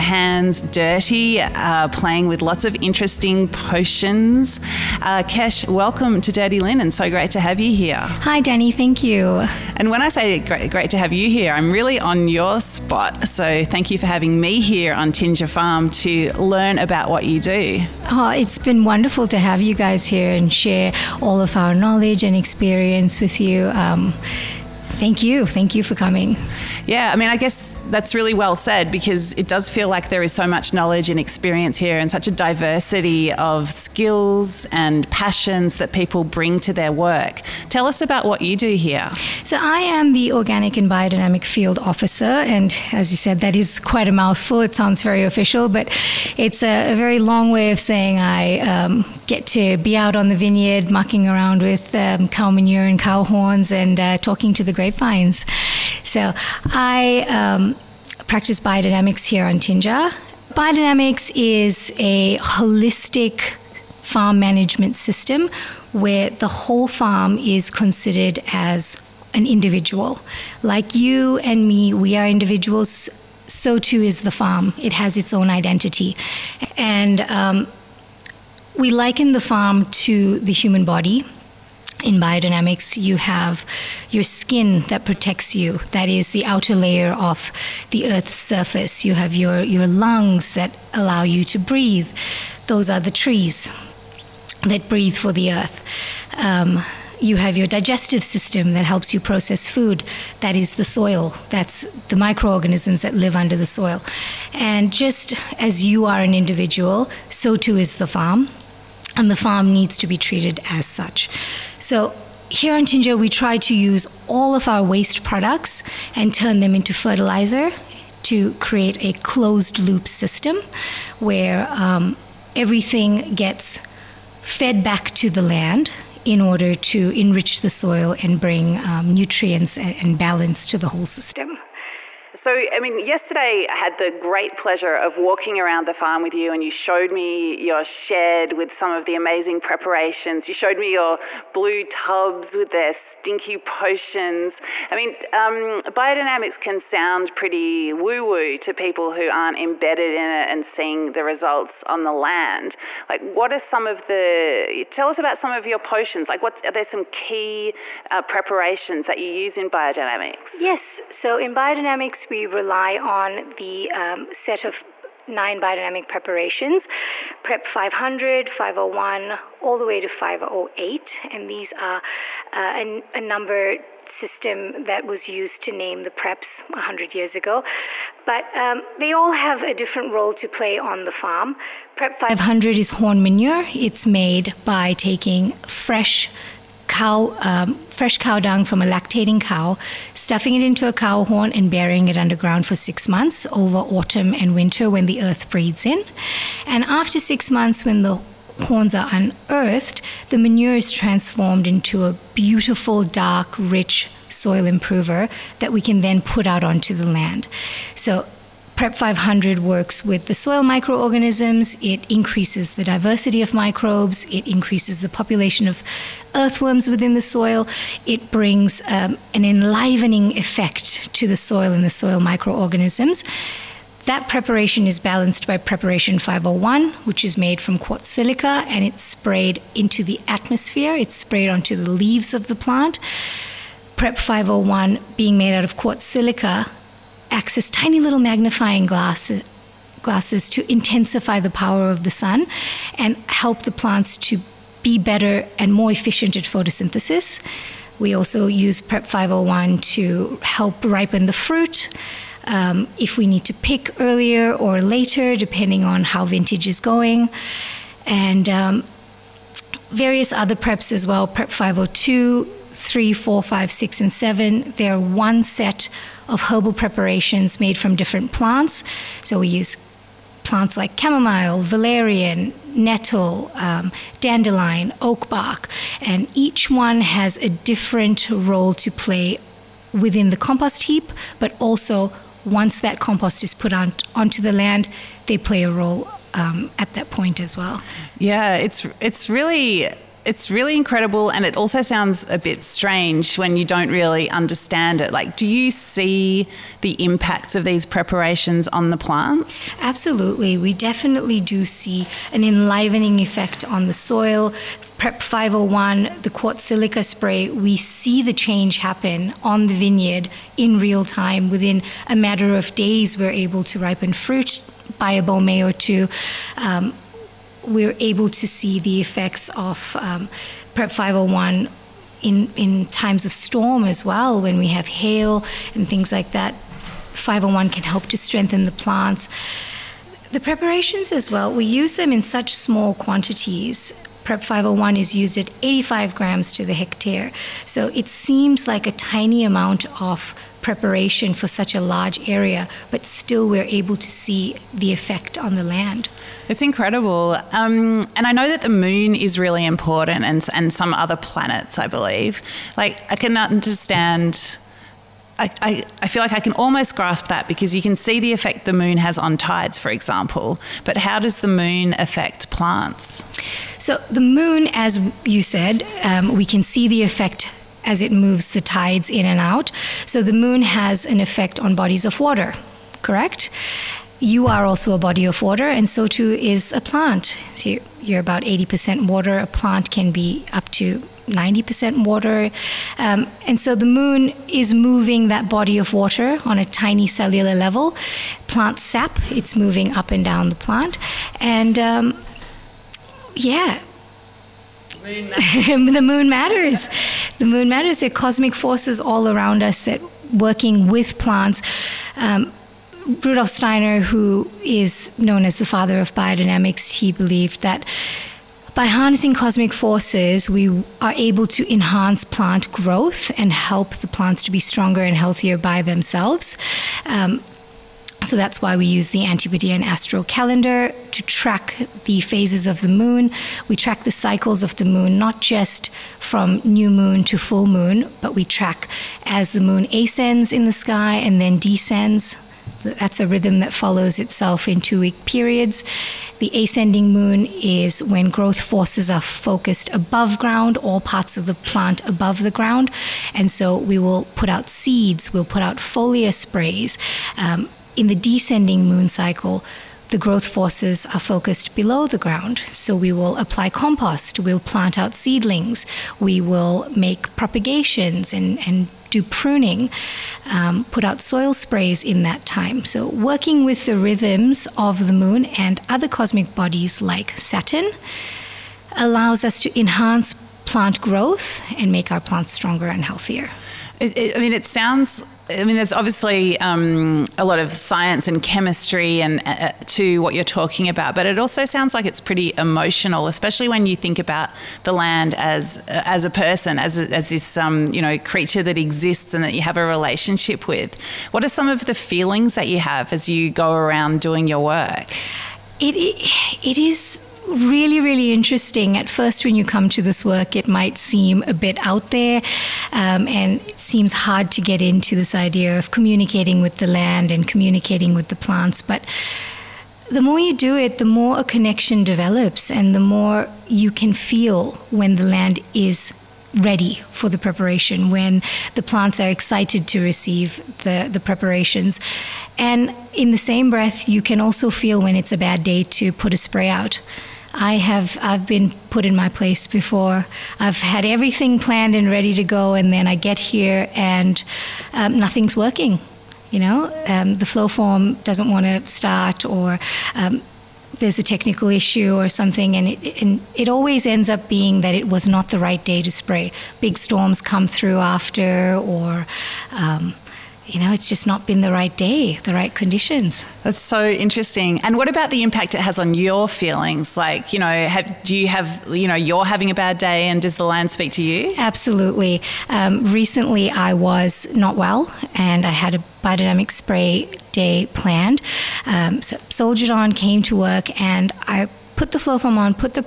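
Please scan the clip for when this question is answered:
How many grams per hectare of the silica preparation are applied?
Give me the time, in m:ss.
5:35.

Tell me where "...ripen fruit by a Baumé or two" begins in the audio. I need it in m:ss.
5:13.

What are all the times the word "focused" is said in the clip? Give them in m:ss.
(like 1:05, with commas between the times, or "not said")
7:19, 7:31.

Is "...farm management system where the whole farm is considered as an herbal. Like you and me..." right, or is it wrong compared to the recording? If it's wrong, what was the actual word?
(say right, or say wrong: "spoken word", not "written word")
wrong: "individual", not "herbal".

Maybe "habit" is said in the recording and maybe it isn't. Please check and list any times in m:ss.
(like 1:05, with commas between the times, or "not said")
not said.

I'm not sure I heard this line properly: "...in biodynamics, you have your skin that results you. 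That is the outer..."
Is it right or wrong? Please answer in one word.
wrong.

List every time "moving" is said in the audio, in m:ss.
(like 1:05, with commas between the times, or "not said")
6:24, 6:29.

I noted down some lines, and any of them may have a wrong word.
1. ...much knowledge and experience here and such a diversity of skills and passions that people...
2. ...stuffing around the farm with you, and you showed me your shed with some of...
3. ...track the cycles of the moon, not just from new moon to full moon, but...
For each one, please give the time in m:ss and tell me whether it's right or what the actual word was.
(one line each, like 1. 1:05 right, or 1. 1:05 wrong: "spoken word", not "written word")
1. 0:30 right
2. 2:15 wrong: "walking", not "stuffing"
3. 7:03 right.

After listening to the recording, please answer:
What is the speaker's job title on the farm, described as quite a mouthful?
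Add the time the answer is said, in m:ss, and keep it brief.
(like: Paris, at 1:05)
Organic and biodynamic field officer, at 0:40.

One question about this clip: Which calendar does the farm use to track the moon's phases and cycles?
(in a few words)
Antipodean astro calendar.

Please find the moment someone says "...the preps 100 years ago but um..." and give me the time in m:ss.
2:56.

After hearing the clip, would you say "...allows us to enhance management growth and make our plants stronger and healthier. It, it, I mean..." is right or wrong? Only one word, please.
wrong.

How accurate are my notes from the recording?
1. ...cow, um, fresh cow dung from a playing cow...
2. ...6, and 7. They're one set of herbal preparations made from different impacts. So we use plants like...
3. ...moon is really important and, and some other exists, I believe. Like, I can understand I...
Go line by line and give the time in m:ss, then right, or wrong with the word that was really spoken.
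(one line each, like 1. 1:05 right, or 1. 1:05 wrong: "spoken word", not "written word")
1. 3:06 wrong: "lactating", not "playing"
2. 4:23 wrong: "plants", not "impacts"
3. 5:48 wrong: "planets", not "exists".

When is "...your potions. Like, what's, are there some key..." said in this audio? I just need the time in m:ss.
2:35.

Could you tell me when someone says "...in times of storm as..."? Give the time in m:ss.
5:22.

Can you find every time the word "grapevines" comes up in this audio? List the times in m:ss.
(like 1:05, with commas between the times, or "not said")
0:54.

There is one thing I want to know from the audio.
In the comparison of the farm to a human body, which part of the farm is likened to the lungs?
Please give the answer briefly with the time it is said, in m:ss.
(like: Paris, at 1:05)
Trees, at 1:33.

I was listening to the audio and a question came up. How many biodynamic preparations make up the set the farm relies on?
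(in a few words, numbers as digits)
9.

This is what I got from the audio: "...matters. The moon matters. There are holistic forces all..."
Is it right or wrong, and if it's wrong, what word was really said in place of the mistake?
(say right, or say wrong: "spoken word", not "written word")
wrong: "cosmic", not "holistic".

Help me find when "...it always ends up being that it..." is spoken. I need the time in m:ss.
9:03.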